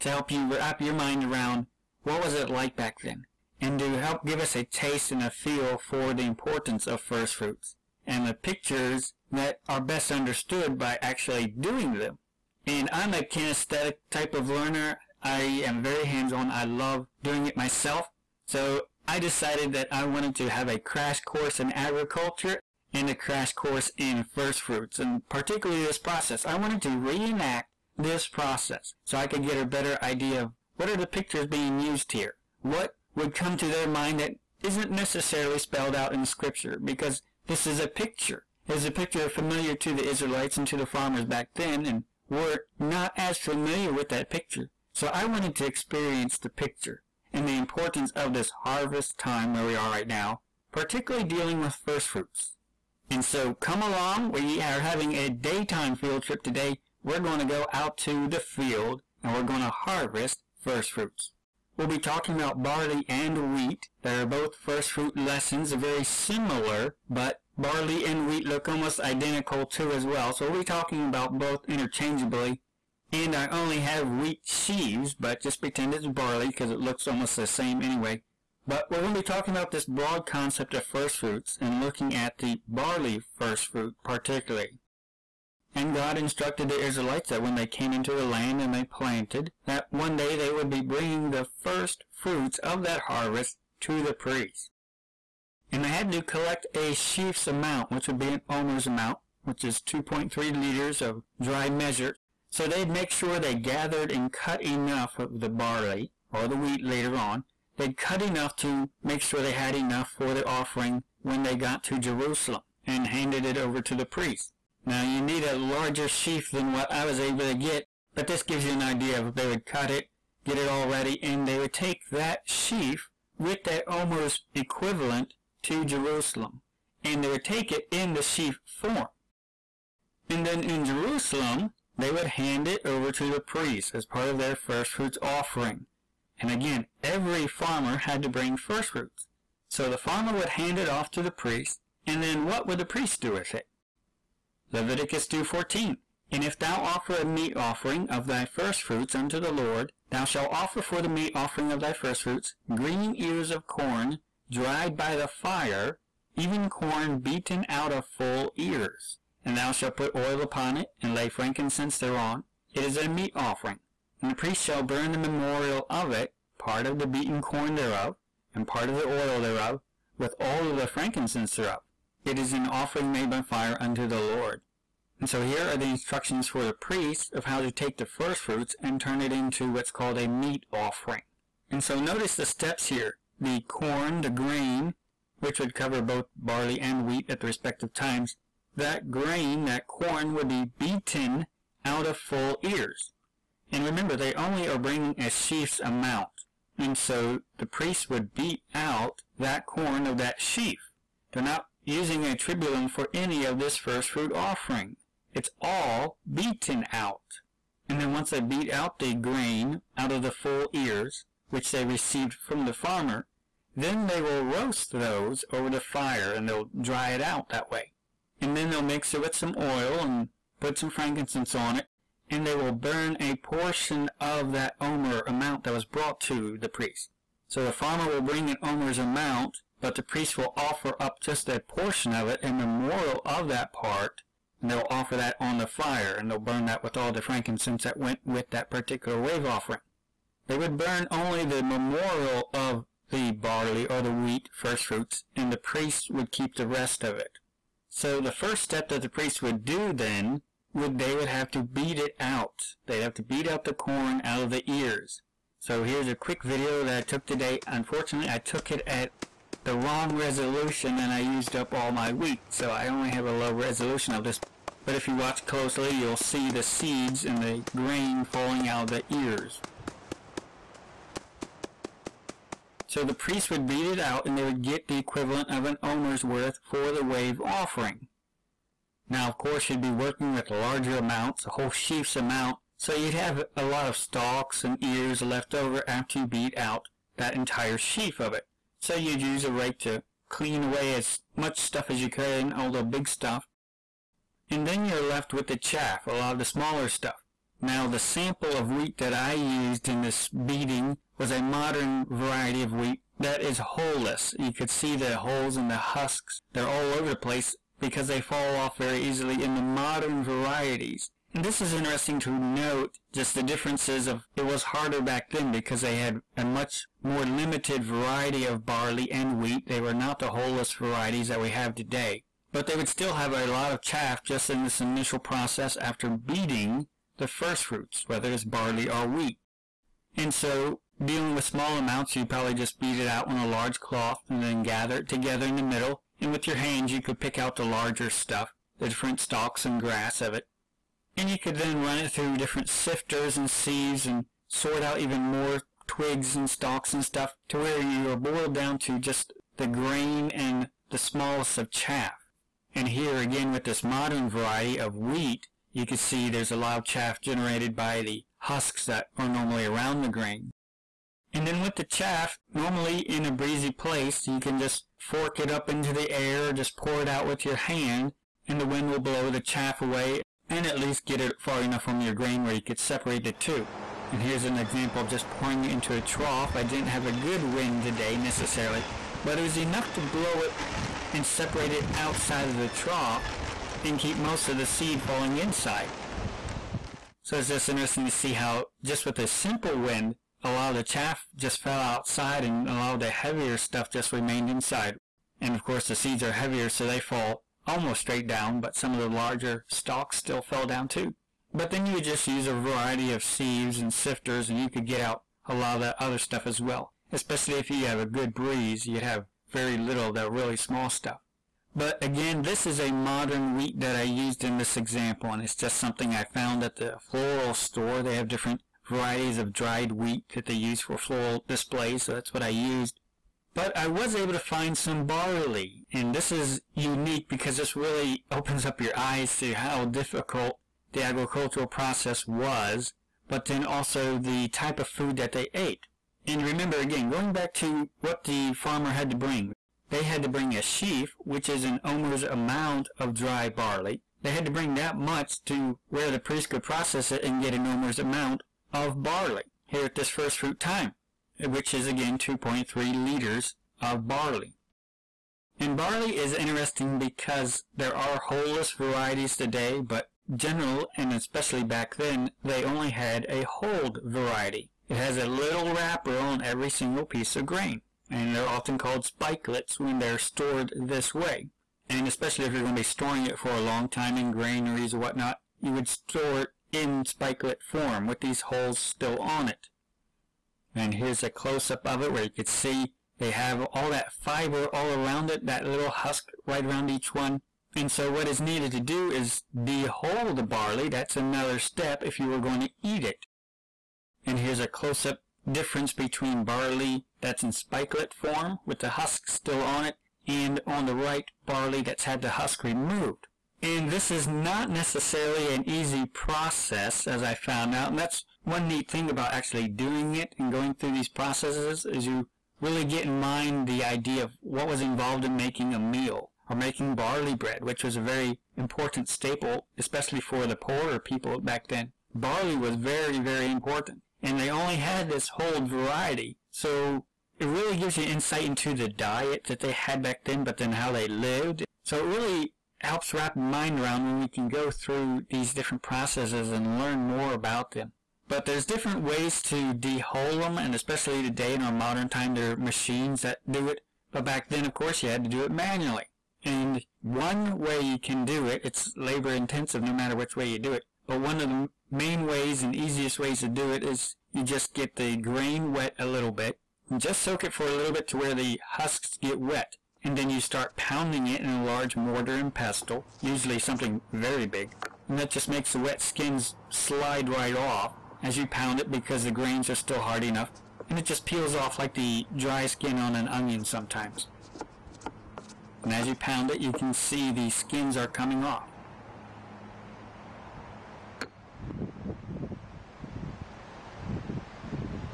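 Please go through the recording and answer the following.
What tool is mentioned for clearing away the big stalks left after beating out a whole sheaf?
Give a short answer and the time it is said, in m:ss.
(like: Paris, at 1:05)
A rake, at 4:49.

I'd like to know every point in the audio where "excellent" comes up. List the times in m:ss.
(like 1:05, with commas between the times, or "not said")
not said.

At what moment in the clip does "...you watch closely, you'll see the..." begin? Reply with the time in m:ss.
4:25.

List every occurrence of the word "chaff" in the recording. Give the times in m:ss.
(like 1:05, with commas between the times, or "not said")
4:55, 5:23, 5:51, 5:56, 6:01, 6:09, 6:30.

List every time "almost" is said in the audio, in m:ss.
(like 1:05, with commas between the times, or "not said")
1:08, 1:17, 6:37.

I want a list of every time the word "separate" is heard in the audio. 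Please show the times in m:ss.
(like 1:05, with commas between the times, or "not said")
6:12, 6:21.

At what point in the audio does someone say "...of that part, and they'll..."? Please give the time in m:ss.
3:53.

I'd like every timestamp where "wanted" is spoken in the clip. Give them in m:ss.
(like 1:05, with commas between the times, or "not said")
0:20, 0:26, 0:45.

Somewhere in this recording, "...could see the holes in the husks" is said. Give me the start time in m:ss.
5:04.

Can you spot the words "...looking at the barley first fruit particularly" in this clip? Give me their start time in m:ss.
1:21.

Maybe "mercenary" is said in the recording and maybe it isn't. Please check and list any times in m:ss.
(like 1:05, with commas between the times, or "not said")
not said.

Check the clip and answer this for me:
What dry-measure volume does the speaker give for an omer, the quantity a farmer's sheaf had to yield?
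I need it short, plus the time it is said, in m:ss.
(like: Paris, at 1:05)
2.3 liters, at 1:39.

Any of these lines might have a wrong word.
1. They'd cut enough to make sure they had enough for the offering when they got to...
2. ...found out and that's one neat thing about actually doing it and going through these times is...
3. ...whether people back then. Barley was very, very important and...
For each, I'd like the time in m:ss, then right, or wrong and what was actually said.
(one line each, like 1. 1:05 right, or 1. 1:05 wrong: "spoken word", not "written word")
1. 1:47 right
2. 8:27 wrong: "processes", not "times"
3. 8:40 wrong: "poorer", not "whether".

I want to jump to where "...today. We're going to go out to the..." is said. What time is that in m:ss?
0:56.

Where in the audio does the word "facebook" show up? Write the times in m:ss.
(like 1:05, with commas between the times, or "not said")
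not said.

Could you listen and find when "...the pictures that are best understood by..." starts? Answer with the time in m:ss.
0:08.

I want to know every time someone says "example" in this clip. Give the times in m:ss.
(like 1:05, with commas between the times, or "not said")
6:14, 6:54.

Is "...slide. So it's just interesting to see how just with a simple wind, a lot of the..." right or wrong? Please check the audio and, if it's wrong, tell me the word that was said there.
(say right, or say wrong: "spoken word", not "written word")
wrong: "inside", not "slide".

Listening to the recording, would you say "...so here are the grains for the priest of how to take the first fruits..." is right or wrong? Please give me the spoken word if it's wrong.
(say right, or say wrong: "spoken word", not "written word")
wrong: "instructions", not "grains".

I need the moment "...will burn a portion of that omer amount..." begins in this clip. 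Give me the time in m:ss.
3:42.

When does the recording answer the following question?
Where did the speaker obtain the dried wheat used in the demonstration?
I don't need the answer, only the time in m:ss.
6:57.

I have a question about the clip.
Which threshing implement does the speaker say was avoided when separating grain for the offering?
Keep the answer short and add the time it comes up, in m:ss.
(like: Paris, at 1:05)
A tribulum, at 3:22.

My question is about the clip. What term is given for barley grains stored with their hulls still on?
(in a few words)
Spikelets.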